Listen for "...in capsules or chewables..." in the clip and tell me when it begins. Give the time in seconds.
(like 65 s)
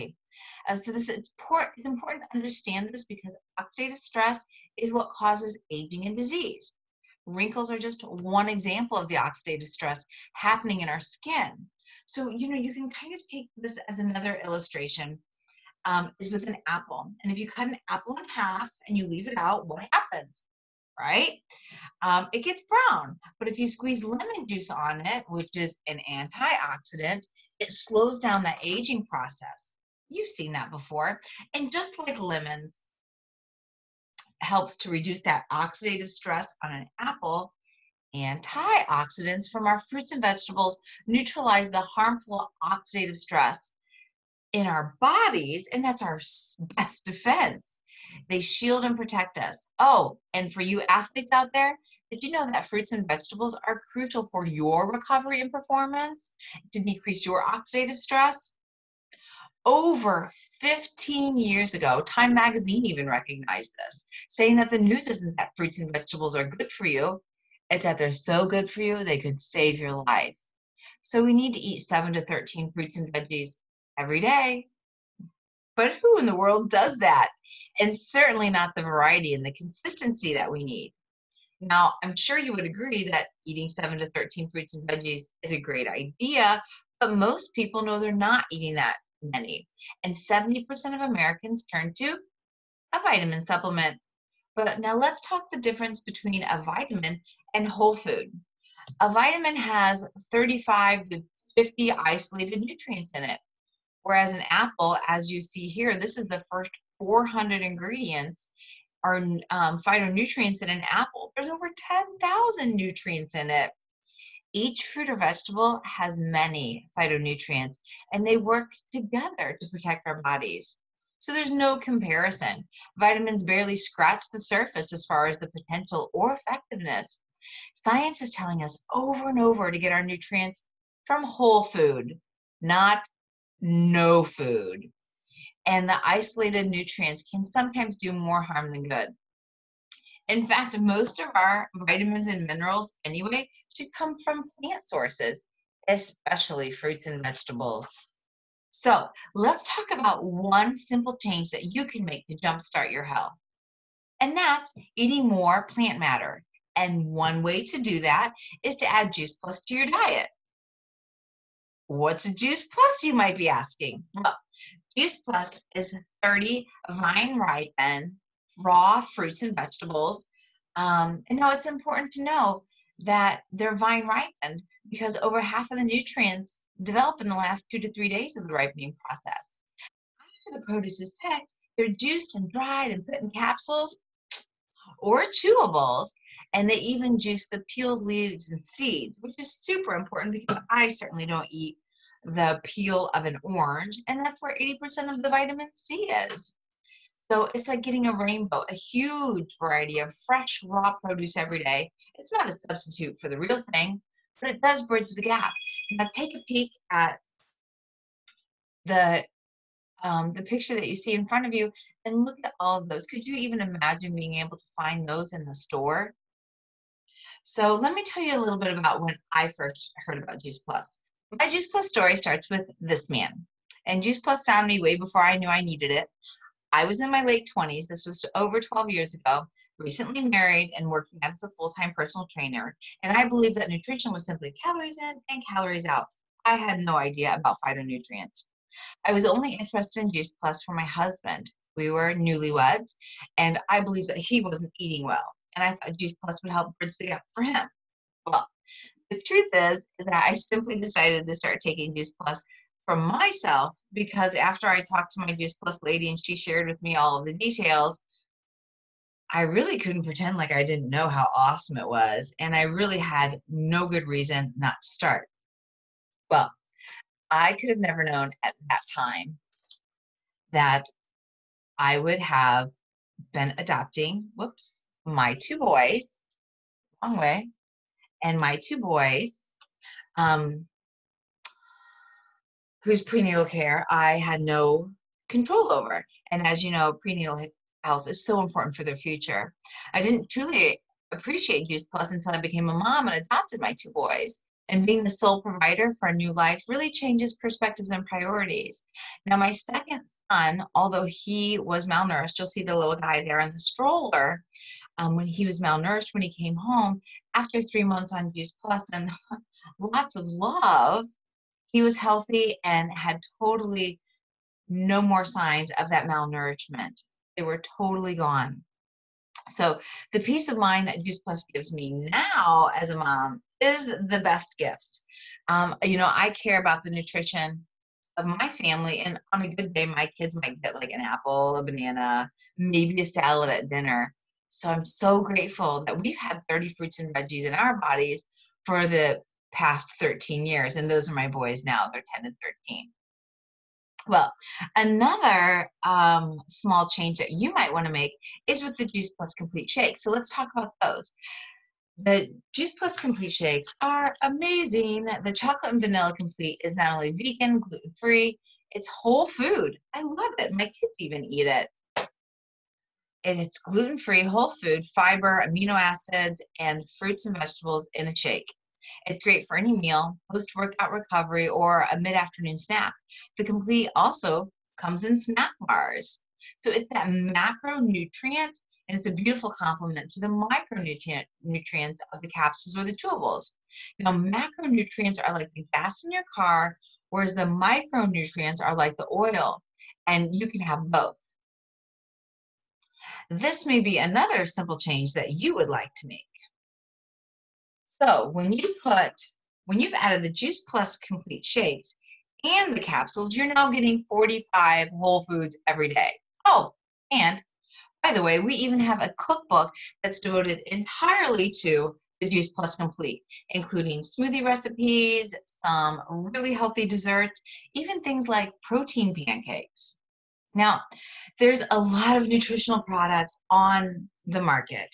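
183 s.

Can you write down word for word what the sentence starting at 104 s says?
Whereas an apple, as you see here, this is the first 400 ingredients are um, phytonutrients in an apple.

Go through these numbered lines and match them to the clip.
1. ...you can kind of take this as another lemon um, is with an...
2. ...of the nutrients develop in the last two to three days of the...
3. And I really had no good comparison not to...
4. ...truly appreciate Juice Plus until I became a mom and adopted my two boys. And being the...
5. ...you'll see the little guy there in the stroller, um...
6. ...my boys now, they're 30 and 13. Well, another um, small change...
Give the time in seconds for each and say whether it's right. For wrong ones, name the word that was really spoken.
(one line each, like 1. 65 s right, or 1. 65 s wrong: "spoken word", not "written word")
1. 12 s wrong: "illustration", not "lemon"
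2. 175 s right
3. 262 s wrong: "reason", not "comparison"
4. 290 s right
5. 302 s right
6. 341 s wrong: "10", not "30".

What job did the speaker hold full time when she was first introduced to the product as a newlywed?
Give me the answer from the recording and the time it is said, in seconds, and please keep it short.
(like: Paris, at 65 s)
personal trainer, at 231 s.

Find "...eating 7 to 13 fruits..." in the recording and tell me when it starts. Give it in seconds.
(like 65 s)
83 s.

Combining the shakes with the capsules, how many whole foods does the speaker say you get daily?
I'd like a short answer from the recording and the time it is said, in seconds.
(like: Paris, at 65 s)
45, at 404 s.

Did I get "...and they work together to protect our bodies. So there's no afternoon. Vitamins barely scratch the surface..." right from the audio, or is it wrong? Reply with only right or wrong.
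wrong.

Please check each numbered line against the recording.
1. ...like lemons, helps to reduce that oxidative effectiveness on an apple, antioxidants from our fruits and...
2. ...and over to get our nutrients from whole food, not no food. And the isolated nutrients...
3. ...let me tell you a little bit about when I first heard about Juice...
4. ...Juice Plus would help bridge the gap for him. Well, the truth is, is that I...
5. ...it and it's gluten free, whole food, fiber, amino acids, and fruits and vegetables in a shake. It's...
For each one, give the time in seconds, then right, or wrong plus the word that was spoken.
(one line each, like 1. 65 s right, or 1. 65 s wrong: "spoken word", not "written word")
1. 31 s wrong: "stress", not "effectiveness"
2. 129 s right
3. 217 s right
4. 245 s right
5. 361 s right.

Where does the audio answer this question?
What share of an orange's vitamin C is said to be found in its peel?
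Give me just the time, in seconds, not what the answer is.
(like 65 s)
194 s.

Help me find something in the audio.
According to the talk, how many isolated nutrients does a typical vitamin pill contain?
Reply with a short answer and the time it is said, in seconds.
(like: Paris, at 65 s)
35 to 50, at 100 s.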